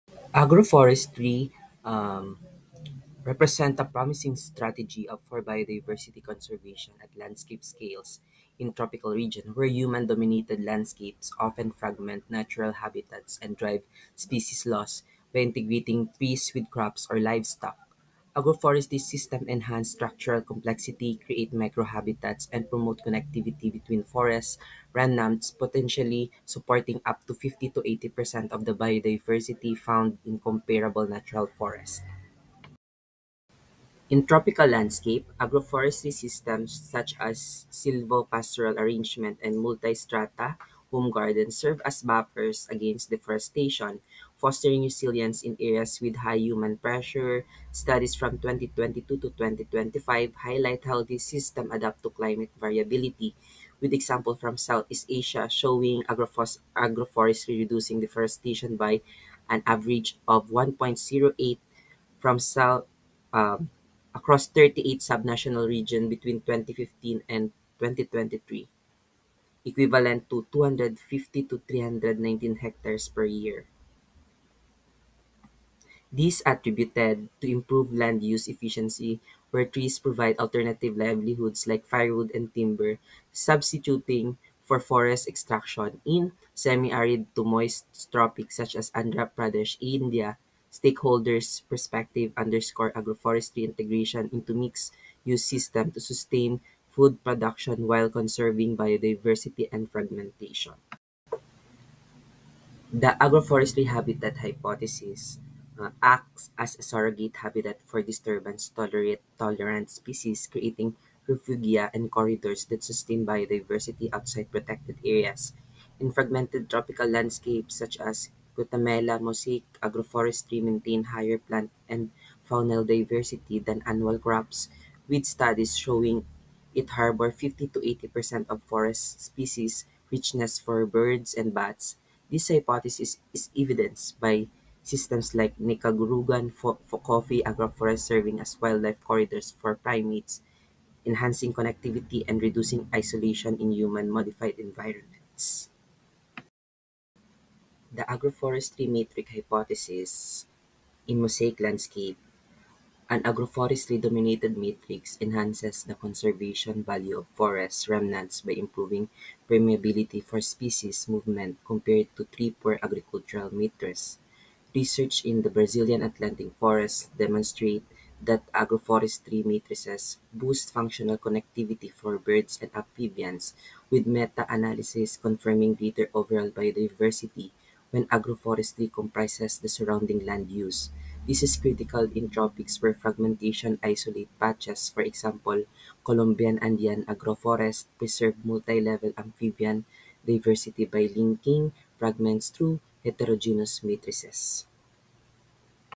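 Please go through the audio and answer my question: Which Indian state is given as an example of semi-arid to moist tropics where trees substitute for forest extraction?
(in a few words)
Andhra Pradesh.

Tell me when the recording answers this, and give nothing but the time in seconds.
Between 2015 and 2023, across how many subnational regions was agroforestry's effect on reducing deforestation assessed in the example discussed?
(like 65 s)
64 s.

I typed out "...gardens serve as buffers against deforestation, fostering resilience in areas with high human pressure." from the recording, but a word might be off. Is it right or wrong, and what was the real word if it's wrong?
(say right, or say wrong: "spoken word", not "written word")
right.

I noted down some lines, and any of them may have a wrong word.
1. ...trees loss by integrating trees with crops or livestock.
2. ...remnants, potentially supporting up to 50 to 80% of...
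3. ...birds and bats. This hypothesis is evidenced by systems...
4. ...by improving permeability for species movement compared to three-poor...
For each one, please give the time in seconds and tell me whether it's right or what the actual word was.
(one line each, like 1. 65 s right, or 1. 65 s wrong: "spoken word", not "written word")
1. 14 s wrong: "species", not "trees"
2. 24 s right
3. 130 s right
4. 158 s right.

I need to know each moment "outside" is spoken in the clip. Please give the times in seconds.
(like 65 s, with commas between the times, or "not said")
114 s.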